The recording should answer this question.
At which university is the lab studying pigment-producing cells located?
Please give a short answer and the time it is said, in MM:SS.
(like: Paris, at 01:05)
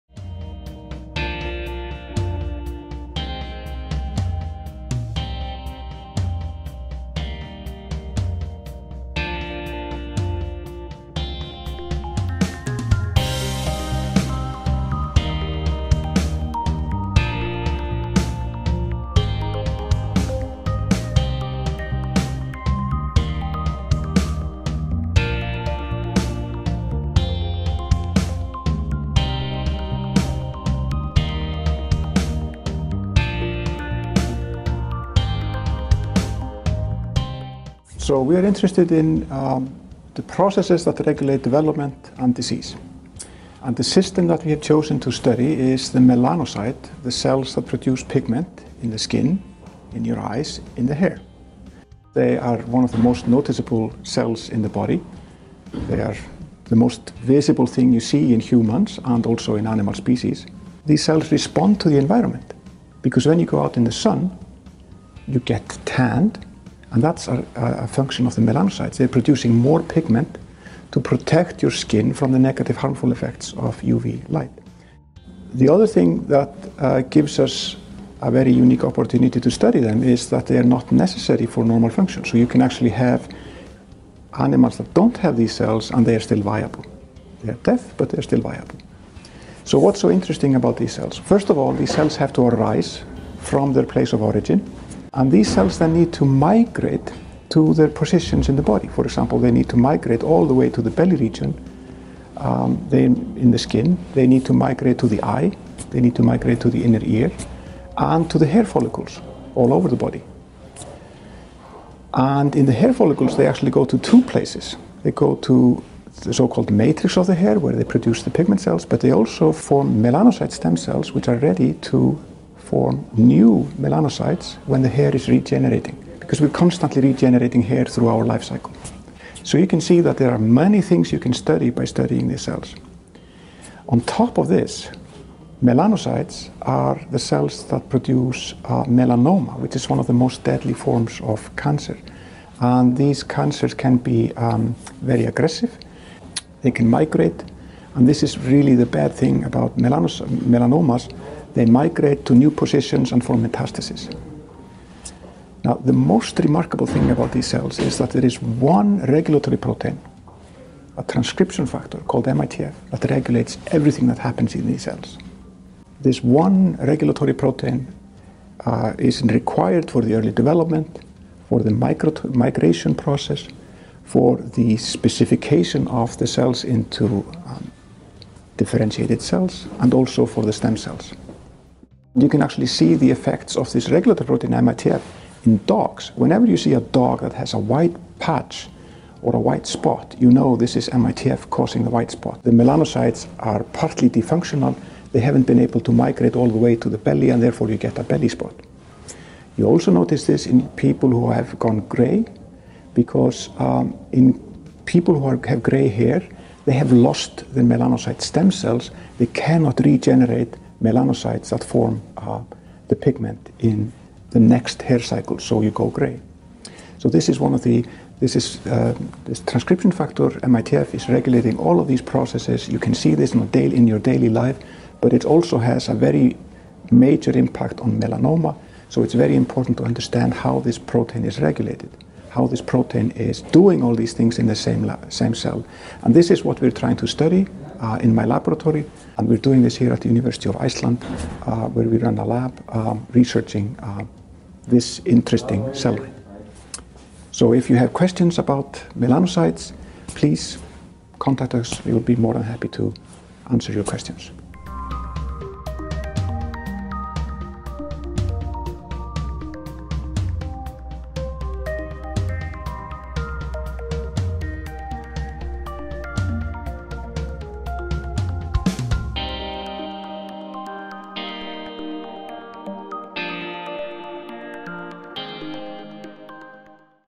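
University of Iceland, at 04:00.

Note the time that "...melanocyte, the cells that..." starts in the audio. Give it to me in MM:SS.
00:45.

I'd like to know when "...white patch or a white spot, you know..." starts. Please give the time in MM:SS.
03:07.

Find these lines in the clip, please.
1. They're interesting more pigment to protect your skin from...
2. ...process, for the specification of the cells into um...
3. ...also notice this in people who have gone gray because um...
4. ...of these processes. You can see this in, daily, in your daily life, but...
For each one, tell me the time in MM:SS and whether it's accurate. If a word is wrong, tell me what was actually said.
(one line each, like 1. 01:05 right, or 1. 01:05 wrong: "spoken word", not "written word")
1. 01:08 wrong: "producing", not "interesting"
2. 02:52 right
3. 03:19 right
4. 03:41 right.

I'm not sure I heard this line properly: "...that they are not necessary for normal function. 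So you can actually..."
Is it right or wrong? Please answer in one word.
right.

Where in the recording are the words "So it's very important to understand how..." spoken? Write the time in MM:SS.
03:48.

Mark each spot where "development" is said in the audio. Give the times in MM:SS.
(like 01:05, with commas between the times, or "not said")
00:41, 02:50.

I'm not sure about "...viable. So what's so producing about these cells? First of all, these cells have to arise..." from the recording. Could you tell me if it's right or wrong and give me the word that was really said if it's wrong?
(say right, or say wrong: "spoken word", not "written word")
wrong: "interesting", not "producing".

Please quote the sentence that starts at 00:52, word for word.
They are one of the most noticeable cells in the body.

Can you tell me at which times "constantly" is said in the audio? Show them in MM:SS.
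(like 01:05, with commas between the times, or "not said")
02:06.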